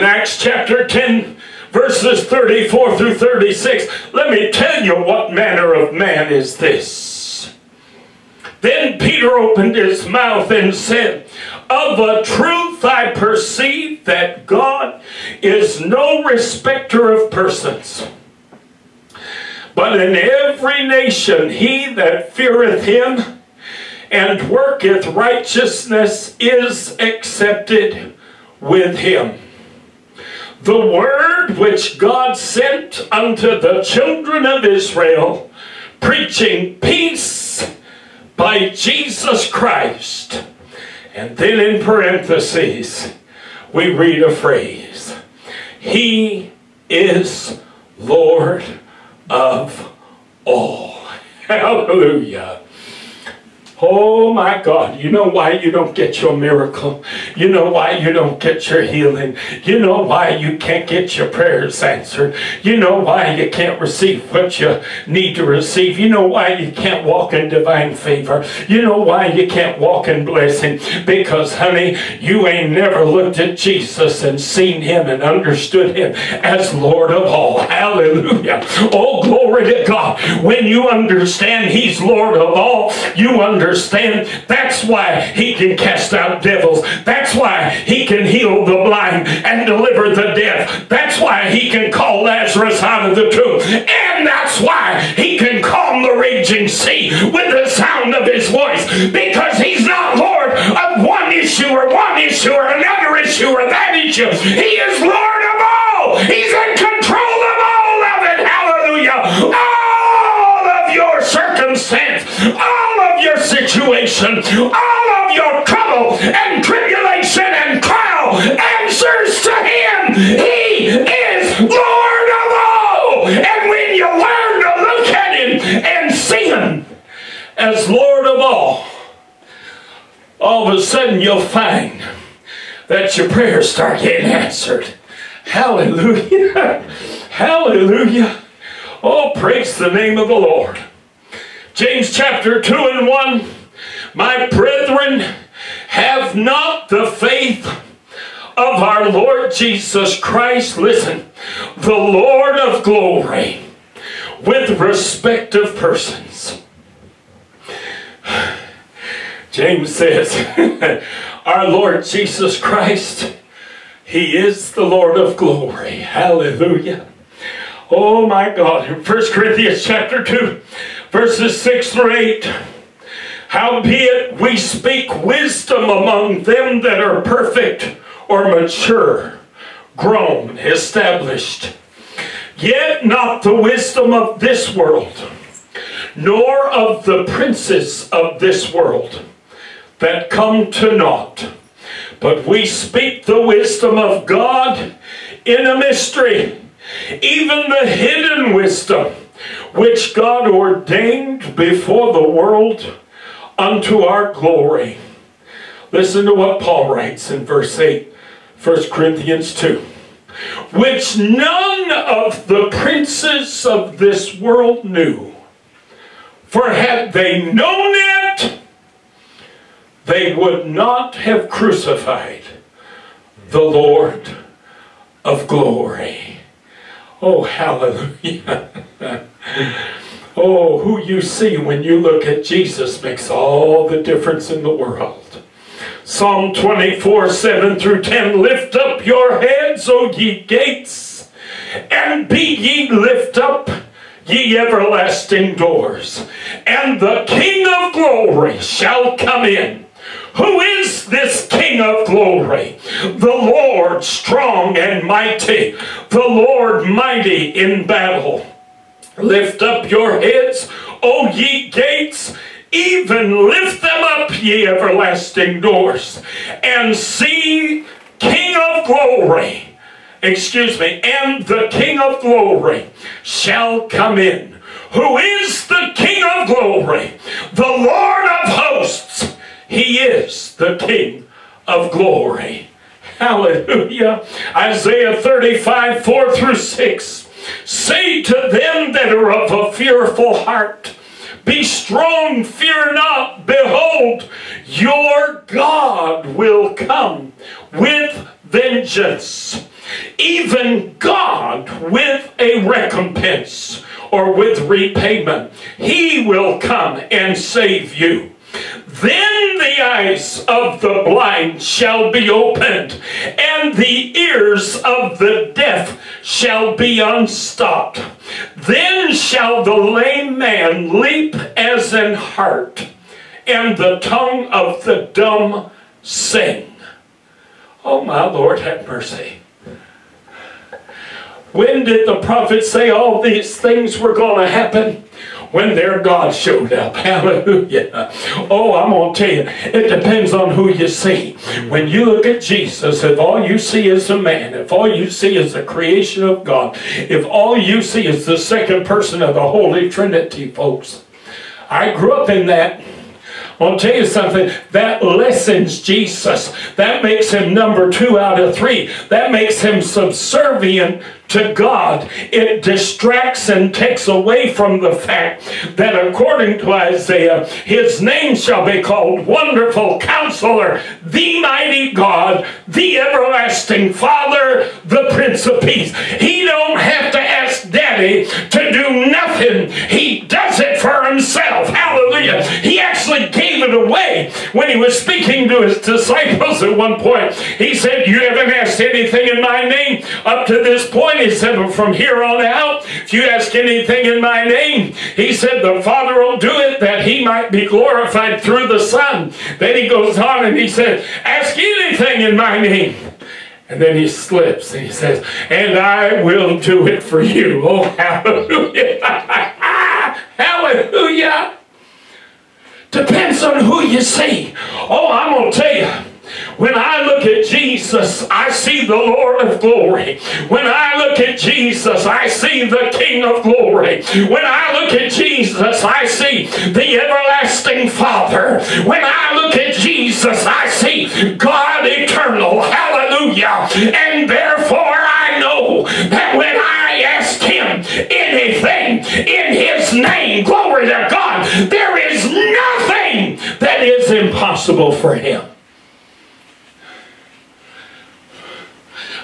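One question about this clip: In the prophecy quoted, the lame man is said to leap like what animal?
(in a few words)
an hart.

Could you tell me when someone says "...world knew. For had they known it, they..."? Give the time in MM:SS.
03:34.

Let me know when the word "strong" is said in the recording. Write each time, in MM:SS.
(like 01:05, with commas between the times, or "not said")
04:14, 04:51.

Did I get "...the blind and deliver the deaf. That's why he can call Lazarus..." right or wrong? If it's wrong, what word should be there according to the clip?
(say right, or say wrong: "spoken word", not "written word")
right.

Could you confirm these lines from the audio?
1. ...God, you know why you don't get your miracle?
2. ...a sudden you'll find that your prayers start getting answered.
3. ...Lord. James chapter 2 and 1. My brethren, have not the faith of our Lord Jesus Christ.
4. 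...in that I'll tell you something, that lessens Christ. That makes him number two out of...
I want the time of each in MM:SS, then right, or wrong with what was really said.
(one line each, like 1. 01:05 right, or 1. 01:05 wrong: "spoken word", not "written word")
1. 00:54 right
2. 02:10 right
3. 02:20 right
4. 05:52 wrong: "Jesus", not "Christ".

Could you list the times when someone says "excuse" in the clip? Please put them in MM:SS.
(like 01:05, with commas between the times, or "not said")
04:30.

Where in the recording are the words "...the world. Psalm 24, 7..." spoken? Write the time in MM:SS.
03:54.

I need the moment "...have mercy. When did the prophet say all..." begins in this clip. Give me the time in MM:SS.
05:28.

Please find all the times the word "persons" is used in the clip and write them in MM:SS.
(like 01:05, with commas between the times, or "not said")
00:17, 02:35, 05:48.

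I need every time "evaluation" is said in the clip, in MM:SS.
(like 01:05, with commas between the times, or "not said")
not said.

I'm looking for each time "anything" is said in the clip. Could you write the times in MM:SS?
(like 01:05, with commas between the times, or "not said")
06:28, 06:33, 06:41, 07:18.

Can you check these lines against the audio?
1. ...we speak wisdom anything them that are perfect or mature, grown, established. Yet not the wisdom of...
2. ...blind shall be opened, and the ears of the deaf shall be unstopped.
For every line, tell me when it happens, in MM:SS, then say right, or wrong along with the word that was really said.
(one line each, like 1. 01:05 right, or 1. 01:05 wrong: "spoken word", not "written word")
1. 02:54 wrong: "among", not "anything"
2. 05:11 right.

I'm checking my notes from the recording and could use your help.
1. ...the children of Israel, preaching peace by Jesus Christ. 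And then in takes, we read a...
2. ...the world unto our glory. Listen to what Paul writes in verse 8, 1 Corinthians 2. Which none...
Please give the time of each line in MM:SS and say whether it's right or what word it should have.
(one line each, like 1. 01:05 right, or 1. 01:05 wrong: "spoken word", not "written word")
1. 00:33 wrong: "parentheses", not "takes"
2. 03:22 right.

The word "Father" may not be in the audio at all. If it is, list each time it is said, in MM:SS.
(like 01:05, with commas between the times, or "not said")
06:13, 06:35, 07:07.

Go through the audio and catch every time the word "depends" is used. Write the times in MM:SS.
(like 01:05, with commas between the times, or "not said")
05:39, 06:52.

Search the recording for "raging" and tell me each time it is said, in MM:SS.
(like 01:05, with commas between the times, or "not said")
01:36.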